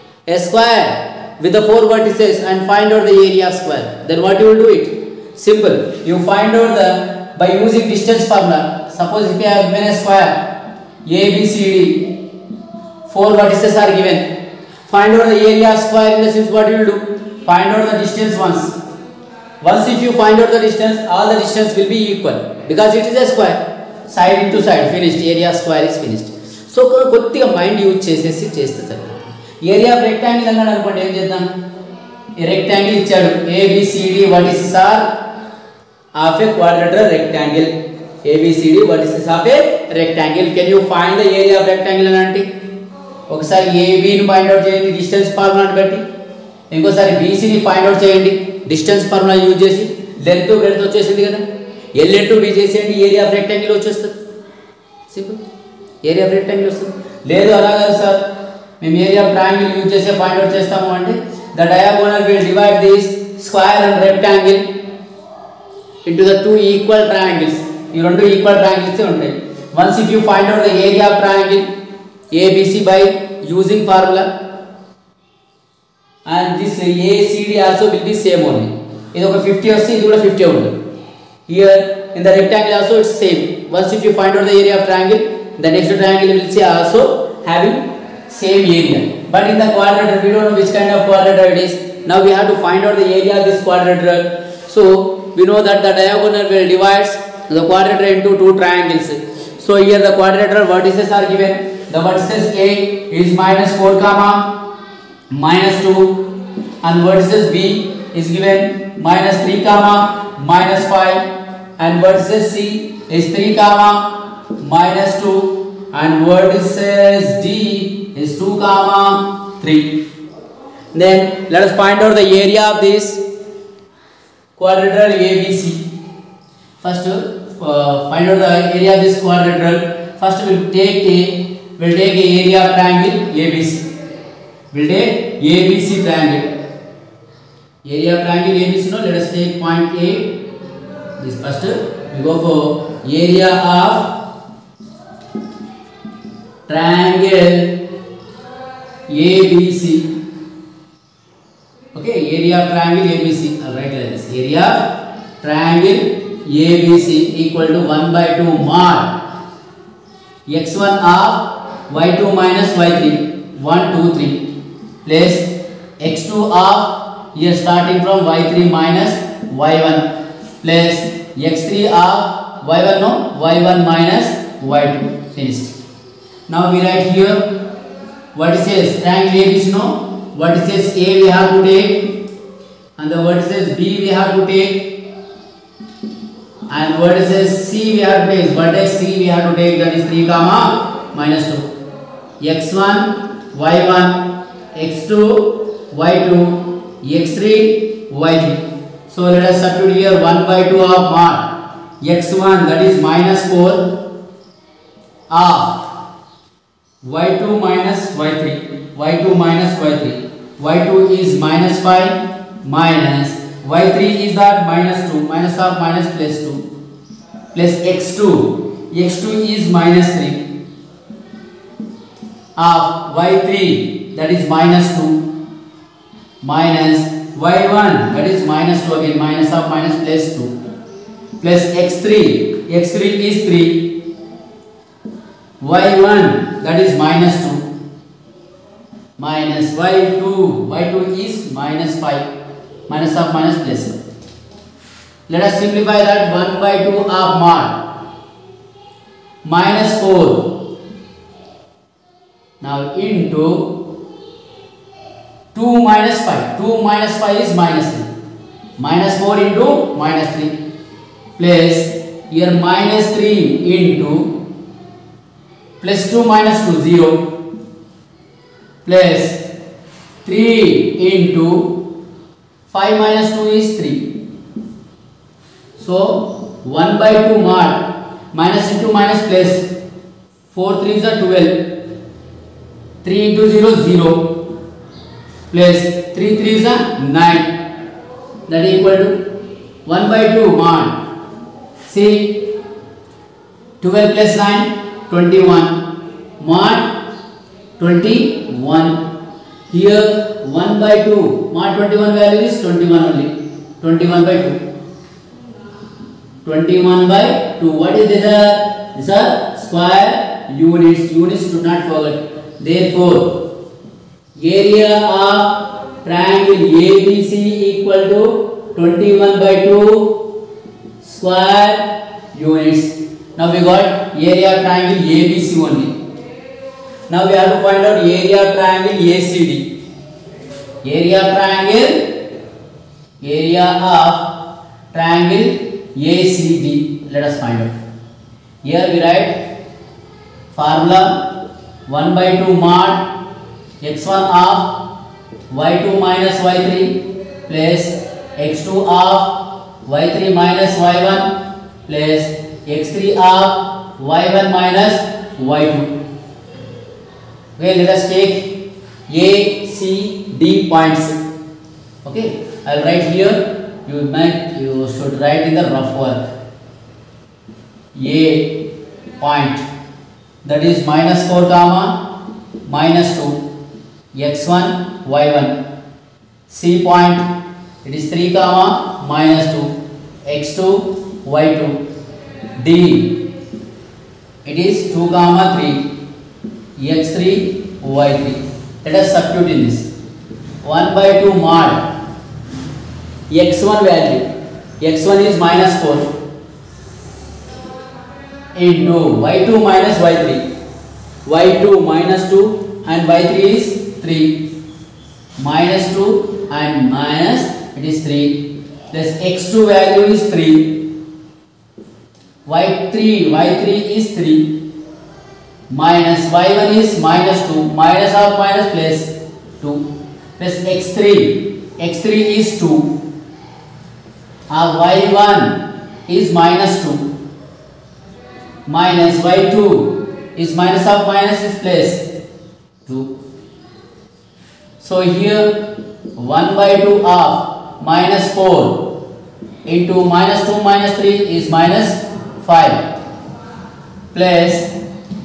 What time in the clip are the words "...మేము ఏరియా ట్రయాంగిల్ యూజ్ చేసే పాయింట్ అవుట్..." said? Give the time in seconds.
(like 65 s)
58 s.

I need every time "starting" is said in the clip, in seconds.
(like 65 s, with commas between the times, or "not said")
167 s.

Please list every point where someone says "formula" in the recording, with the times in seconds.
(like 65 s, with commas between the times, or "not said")
8 s, 340 s.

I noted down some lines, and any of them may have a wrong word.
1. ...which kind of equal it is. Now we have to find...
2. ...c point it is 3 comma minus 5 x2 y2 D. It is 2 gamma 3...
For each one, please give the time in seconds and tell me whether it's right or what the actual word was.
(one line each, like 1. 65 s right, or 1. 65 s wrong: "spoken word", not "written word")
1. 90 s wrong: "quadrilateral", not "equal"
2. 376 s wrong: "2", not "5".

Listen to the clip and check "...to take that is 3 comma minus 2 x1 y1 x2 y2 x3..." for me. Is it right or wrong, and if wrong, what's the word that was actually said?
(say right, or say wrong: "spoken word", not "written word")
right.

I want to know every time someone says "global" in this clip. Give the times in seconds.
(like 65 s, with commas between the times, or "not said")
not said.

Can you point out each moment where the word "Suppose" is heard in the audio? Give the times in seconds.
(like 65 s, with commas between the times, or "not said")
8 s.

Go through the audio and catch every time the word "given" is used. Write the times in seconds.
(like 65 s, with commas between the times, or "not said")
9 s, 13 s, 101 s, 108 s.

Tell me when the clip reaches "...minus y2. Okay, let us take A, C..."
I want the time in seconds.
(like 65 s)
354 s.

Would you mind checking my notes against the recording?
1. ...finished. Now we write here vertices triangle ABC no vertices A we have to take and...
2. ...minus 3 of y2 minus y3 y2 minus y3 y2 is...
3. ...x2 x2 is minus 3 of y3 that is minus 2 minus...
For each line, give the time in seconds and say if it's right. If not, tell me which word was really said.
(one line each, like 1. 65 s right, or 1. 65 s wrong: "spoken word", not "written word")
1. 175 s right
2. 203 s wrong: "4", not "3"
3. 217 s right.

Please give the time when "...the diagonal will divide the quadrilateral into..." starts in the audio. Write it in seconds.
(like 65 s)
95 s.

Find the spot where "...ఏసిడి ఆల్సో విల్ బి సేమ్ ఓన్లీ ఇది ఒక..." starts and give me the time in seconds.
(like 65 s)
77 s.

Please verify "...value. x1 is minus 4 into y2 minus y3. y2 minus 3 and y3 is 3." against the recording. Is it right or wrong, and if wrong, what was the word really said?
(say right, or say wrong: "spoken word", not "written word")
wrong: "2", not "3".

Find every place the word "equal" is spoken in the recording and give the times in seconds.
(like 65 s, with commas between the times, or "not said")
22 s, 157 s, 288 s, 317 s.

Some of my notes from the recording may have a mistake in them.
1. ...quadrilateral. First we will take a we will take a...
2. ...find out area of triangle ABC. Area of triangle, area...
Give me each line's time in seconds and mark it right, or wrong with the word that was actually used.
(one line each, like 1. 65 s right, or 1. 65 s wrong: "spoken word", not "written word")
1. 129 s right
2. 327 s wrong: "ACD", not "ABC".